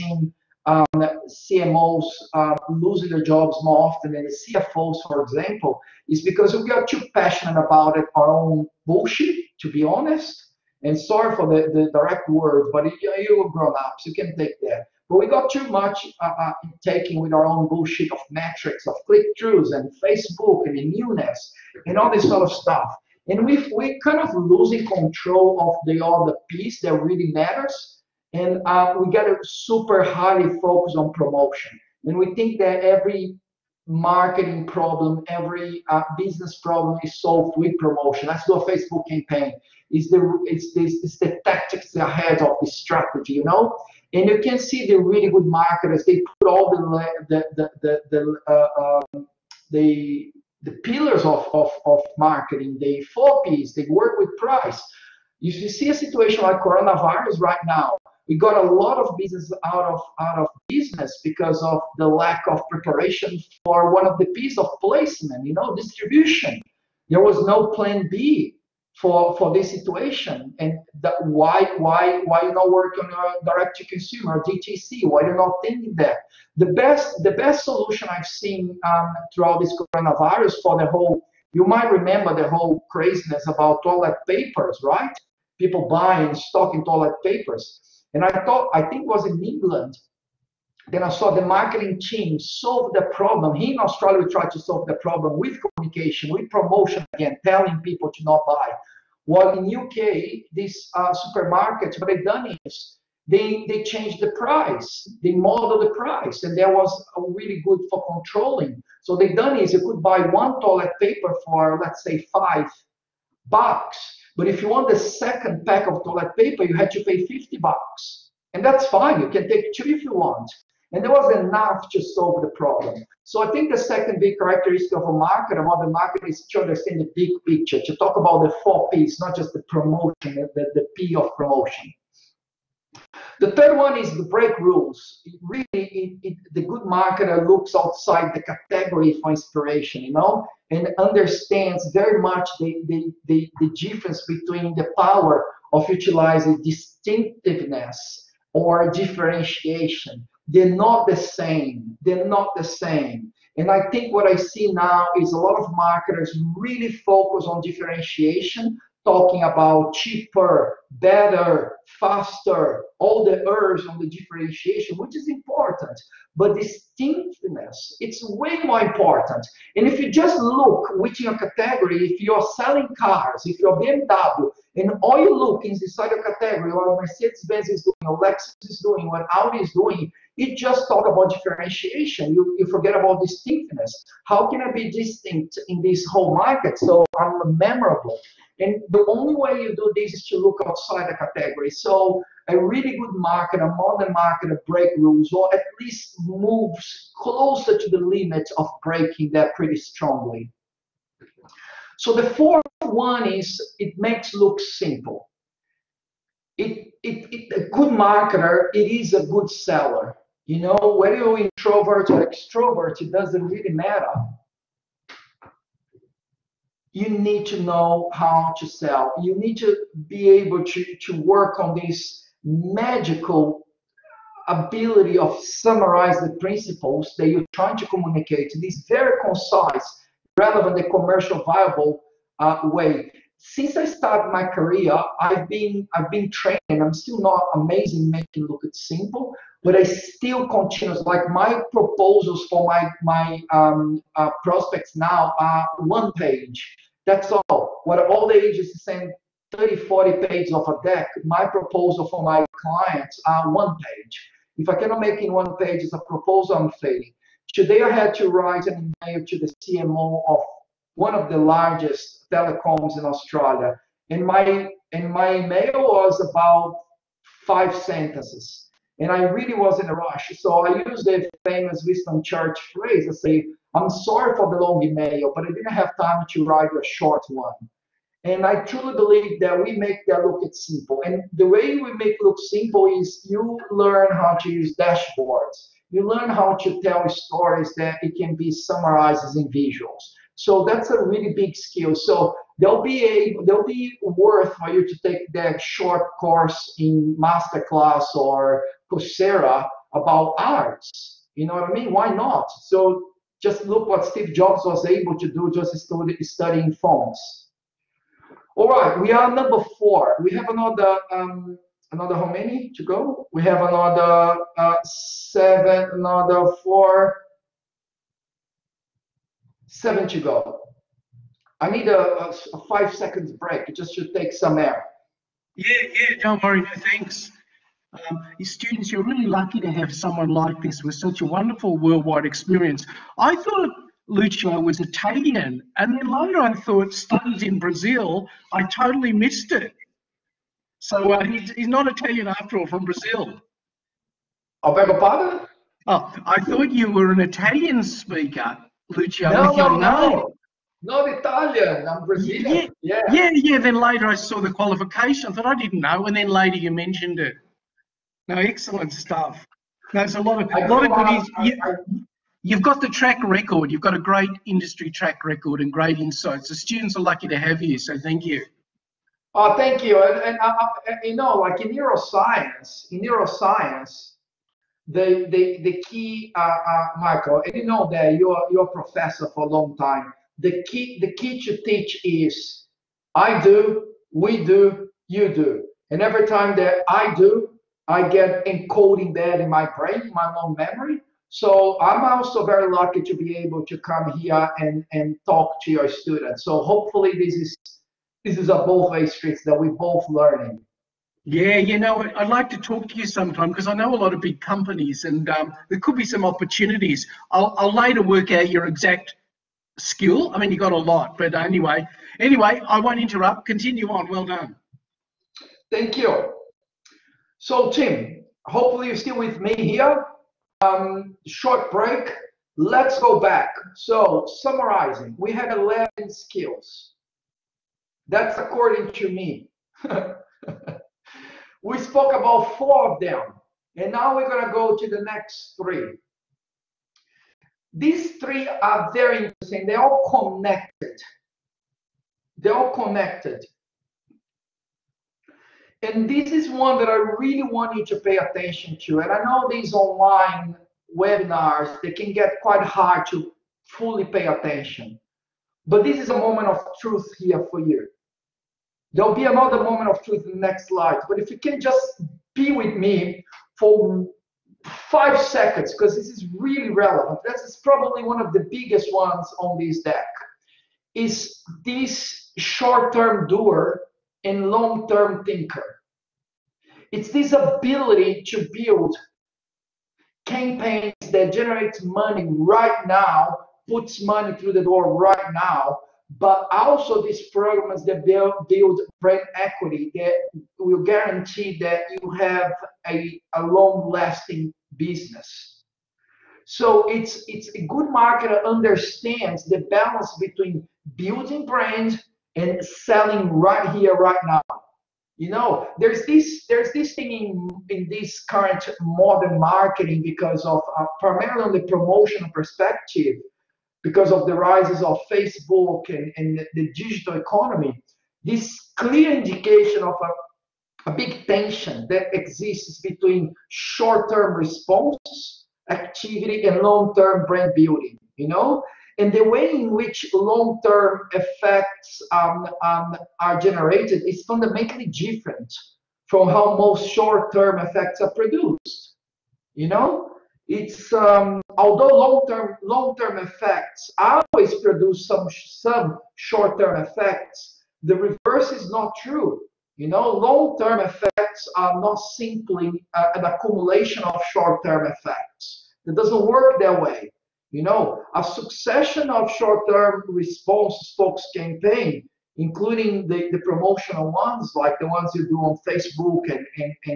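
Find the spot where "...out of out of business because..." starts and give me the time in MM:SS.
00:59.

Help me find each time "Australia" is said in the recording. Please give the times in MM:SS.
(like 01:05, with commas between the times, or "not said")
01:33, 04:23.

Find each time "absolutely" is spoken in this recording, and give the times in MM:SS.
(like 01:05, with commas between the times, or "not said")
not said.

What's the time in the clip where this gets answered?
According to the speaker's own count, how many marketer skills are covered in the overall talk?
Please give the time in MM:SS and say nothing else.
07:05.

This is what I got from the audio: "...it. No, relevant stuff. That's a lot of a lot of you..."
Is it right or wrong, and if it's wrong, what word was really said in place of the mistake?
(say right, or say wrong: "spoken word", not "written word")
wrong: "excellent", not "relevant".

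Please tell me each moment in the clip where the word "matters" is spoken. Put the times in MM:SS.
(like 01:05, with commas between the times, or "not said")
00:27, 03:33.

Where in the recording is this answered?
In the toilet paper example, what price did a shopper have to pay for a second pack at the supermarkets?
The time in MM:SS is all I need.
01:57.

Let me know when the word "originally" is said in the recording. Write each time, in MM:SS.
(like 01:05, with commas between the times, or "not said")
not said.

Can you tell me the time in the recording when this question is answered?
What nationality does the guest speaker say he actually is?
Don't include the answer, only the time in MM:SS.
05:52.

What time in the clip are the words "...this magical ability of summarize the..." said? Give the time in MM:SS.
03:41.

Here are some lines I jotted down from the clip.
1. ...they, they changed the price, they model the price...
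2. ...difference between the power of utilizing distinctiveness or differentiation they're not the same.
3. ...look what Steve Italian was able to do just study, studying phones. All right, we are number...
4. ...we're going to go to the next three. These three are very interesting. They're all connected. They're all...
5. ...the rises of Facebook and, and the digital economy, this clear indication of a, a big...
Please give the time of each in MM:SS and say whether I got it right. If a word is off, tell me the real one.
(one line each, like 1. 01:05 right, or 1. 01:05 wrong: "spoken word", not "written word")
1. 01:43 right
2. 02:23 right
3. 05:03 wrong: "Jobs", not "Italian"
4. 07:14 right
5. 08:34 right.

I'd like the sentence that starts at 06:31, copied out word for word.
So I'm also very lucky to be able to come here and, and talk to your students.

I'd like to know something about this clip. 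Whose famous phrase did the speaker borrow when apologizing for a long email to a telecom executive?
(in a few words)
Winston Churchill.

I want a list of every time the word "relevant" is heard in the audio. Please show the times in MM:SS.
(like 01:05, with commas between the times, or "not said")
03:50, 07:46.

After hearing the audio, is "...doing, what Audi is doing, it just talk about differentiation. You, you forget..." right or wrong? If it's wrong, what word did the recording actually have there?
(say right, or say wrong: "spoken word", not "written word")
right.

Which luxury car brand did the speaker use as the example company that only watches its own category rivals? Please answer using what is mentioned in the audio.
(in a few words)
BMW.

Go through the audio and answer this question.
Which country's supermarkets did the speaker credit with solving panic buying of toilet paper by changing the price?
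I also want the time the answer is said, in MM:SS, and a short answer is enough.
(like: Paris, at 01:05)
England, at 01:29.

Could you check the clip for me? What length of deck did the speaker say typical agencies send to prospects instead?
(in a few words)
30 to 40 pages.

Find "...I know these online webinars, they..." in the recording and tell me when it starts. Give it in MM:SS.
07:29.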